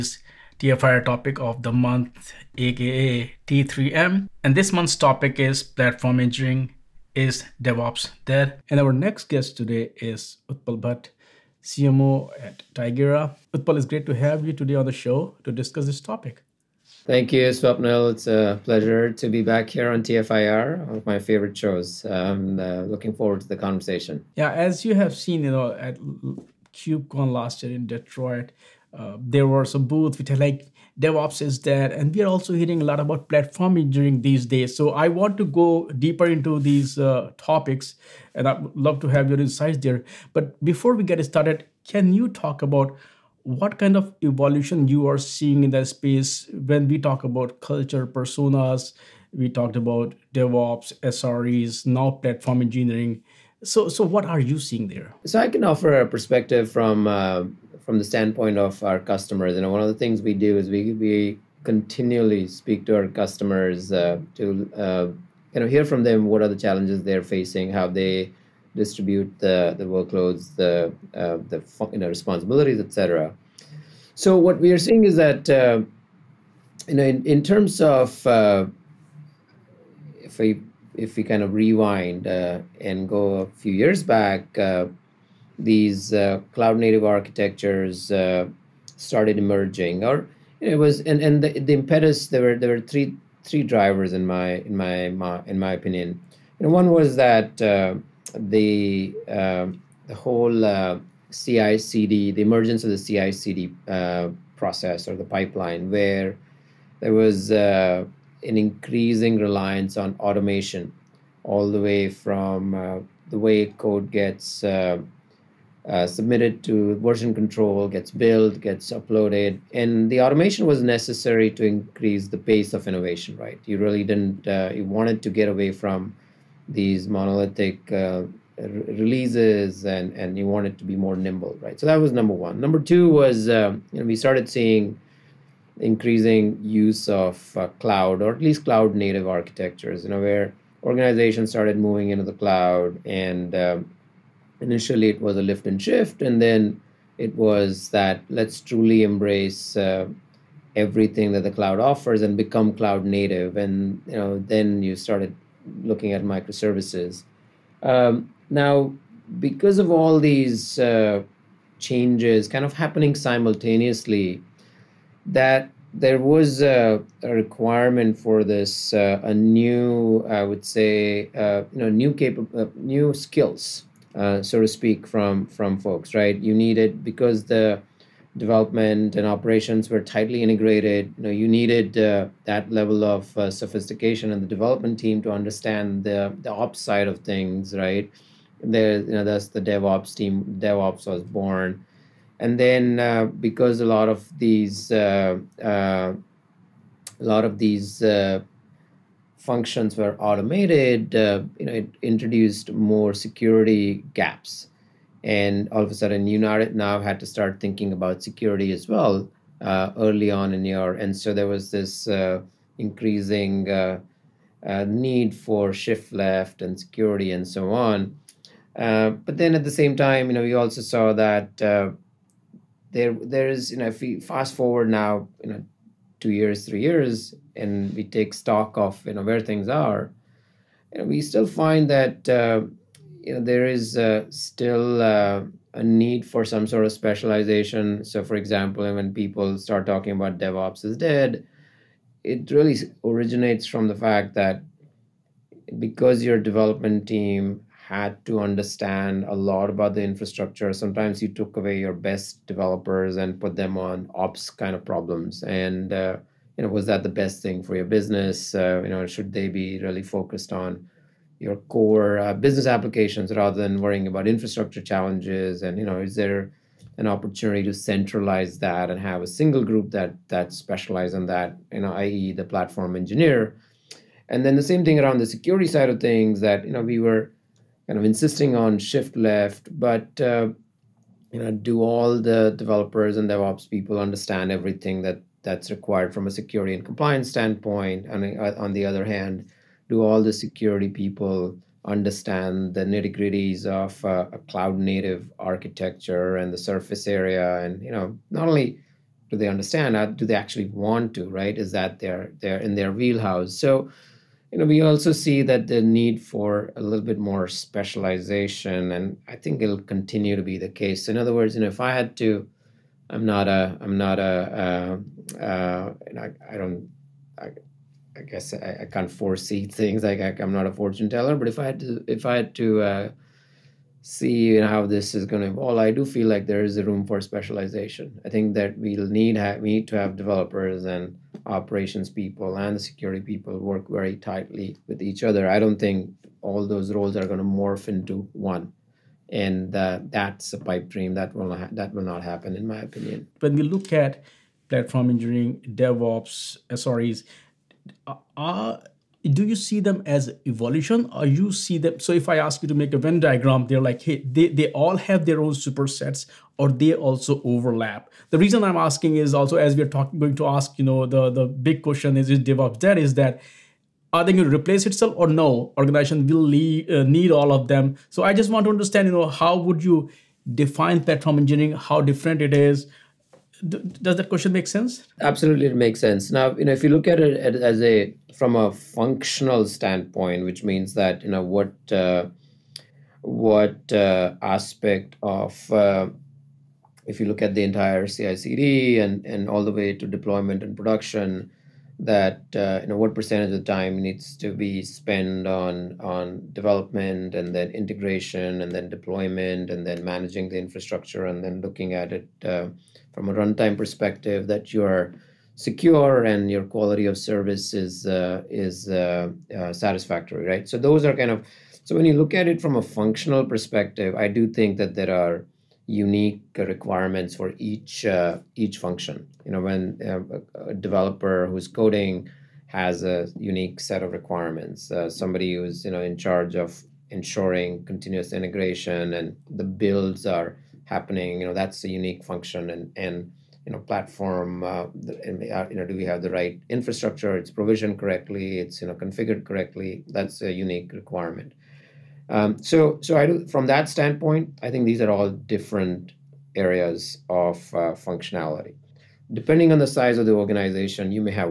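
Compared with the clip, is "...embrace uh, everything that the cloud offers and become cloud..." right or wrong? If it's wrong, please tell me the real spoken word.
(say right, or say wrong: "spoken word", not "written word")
right.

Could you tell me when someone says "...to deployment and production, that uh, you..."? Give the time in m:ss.
6:29.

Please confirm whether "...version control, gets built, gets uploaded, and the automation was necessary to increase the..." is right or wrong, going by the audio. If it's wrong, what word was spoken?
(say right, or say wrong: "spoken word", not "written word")
right.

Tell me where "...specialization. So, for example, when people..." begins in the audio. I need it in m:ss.
3:56.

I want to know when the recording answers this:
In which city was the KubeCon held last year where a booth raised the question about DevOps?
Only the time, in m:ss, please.
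0:27.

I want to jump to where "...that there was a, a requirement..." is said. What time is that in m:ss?
2:45.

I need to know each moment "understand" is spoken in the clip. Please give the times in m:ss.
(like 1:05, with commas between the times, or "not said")
3:05, 4:08, 4:43, 4:51, 4:59, 6:08.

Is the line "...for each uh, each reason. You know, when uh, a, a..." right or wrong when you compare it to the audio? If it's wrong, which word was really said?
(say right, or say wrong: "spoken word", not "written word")
wrong: "function", not "reason".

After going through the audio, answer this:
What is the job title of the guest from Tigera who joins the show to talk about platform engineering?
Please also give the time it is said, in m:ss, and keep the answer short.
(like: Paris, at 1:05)
CMO, at 0:11.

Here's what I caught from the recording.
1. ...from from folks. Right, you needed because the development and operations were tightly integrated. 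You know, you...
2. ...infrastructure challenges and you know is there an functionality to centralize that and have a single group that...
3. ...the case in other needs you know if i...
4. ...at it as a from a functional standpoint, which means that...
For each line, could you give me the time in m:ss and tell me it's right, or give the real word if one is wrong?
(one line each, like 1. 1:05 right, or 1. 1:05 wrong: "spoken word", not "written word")
1. 2:55 right
2. 4:24 wrong: "opportunity", not "functionality"
3. 5:10 wrong: "words", not "needs"
4. 6:17 right.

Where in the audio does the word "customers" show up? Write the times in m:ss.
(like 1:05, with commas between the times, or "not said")
0:58, 1:03.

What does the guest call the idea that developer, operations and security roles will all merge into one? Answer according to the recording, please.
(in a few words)
a pipe dream.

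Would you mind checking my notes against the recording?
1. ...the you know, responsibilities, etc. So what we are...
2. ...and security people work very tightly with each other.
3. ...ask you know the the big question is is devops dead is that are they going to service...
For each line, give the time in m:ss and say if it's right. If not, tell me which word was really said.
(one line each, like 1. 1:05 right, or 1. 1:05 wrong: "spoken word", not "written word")
1. 1:11 right
2. 5:32 right
3. 6:00 wrong: "replace", not "service".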